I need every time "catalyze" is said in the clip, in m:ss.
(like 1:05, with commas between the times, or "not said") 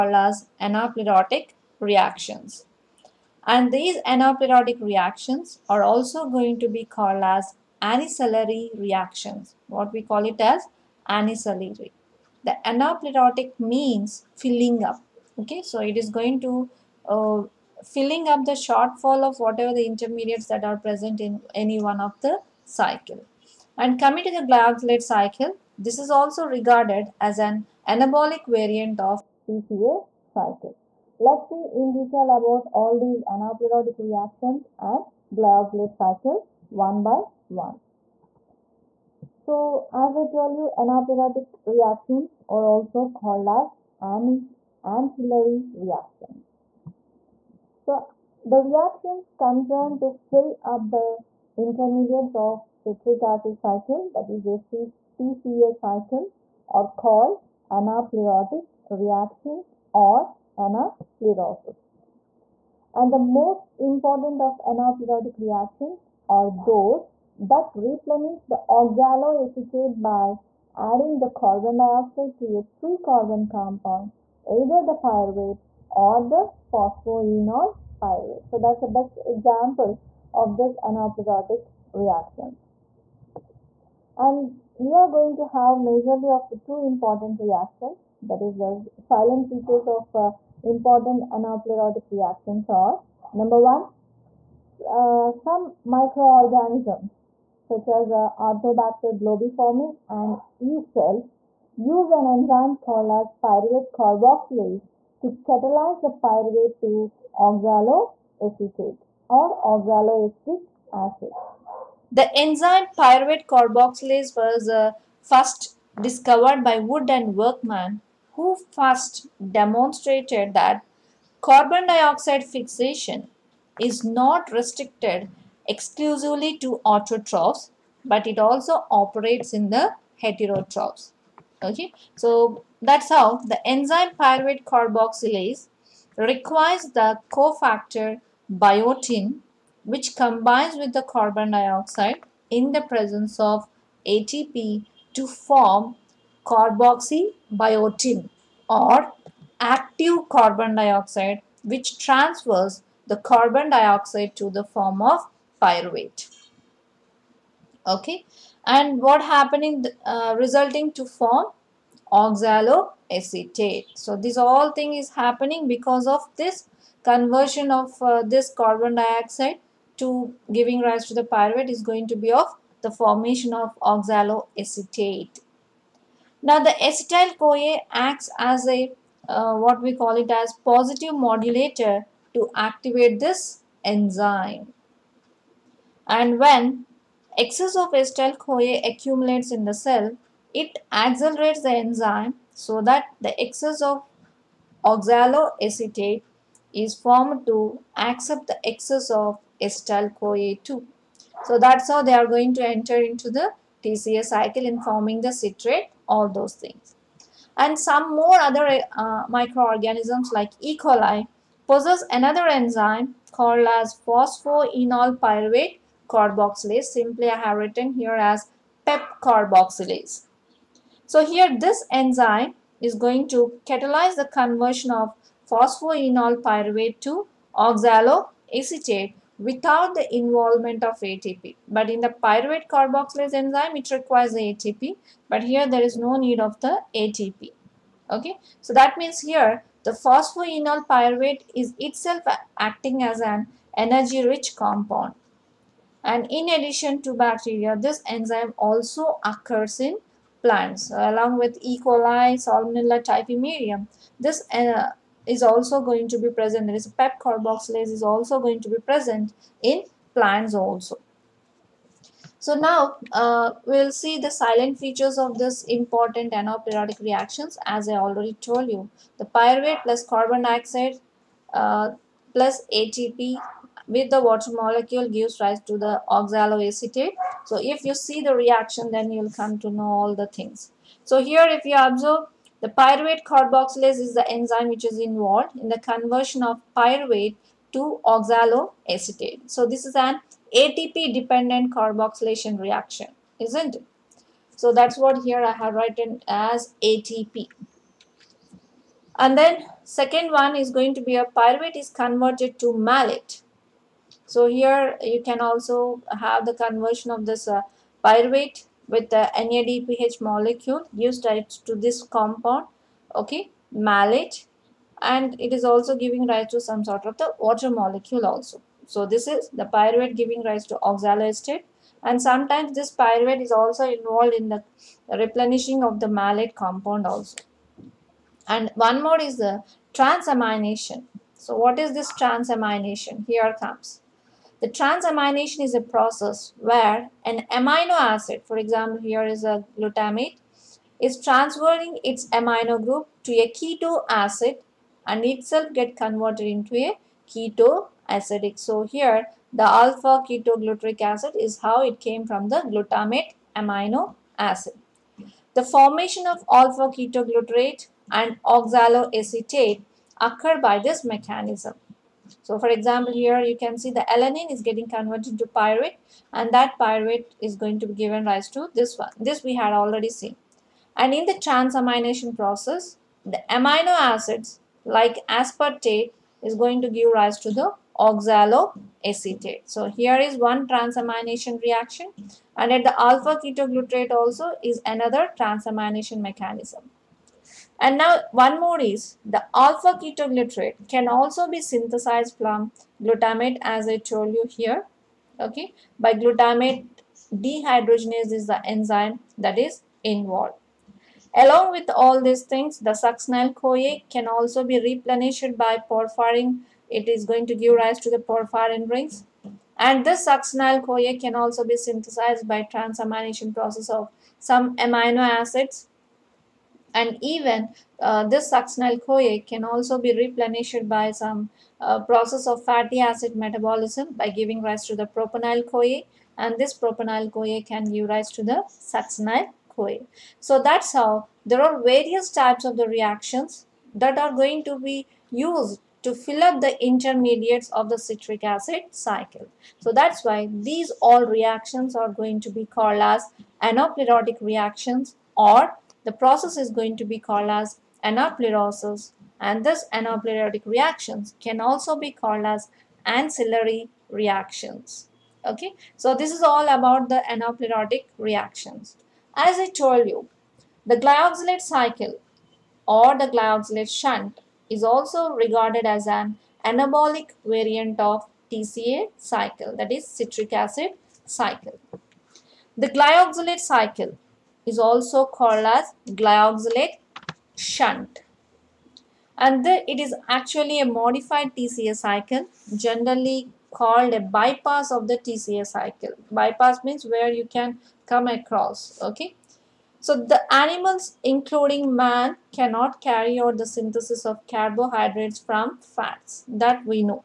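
1:45, 3:43.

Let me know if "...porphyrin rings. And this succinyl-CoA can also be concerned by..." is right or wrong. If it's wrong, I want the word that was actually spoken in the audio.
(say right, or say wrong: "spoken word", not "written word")
wrong: "synthesized", not "concerned".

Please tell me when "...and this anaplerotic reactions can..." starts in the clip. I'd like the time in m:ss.
7:29.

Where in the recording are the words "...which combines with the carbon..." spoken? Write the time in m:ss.
2:19.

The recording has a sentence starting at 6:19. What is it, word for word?
So here is one transamination reaction and at the alpha ketoglutarate also is another transamination mechanism.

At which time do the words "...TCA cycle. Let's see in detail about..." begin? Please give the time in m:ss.
0:29.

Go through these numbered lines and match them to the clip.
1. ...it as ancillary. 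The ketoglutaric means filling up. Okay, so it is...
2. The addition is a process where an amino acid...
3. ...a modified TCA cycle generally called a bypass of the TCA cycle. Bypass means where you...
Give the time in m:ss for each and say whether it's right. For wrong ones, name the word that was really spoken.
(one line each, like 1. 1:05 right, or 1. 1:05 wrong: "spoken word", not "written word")
1. 0:10 wrong: "anaplerotic", not "ketoglutaric"
2. 5:34 wrong: "transamination", not "addition"
3. 8:00 right.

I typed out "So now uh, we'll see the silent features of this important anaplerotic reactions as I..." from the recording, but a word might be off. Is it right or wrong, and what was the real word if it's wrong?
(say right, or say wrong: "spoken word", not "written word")
right.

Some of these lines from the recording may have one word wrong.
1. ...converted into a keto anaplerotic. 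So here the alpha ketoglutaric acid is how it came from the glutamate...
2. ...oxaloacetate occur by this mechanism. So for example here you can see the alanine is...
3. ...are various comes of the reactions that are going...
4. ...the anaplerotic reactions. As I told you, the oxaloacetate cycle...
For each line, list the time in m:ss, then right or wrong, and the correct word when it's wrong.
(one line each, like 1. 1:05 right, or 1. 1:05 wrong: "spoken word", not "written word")
1. 5:45 wrong: "acidic", not "anaplerotic"
2. 5:58 right
3. 7:11 wrong: "types", not "comes"
4. 7:37 wrong: "glyoxylate", not "oxaloacetate".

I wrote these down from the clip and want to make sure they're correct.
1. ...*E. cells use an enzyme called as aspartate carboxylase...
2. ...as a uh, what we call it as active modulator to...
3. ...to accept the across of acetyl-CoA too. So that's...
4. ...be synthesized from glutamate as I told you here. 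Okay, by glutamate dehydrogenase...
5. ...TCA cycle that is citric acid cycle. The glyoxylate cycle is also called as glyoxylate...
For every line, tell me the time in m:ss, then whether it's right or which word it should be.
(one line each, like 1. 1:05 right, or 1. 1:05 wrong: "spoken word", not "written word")
1. 1:40 wrong: "pyruvate", not "aspartate"
2. 2:58 wrong: "positive", not "active"
3. 3:17 wrong: "excess", not "across"
4. 6:31 right
5. 7:48 right.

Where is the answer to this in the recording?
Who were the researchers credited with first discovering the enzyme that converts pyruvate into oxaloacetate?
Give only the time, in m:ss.
1:56.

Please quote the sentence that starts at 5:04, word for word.
So here you can also have the conversion of this uh, pyruvate with the NADPH molecule used to this compound, okay, malate.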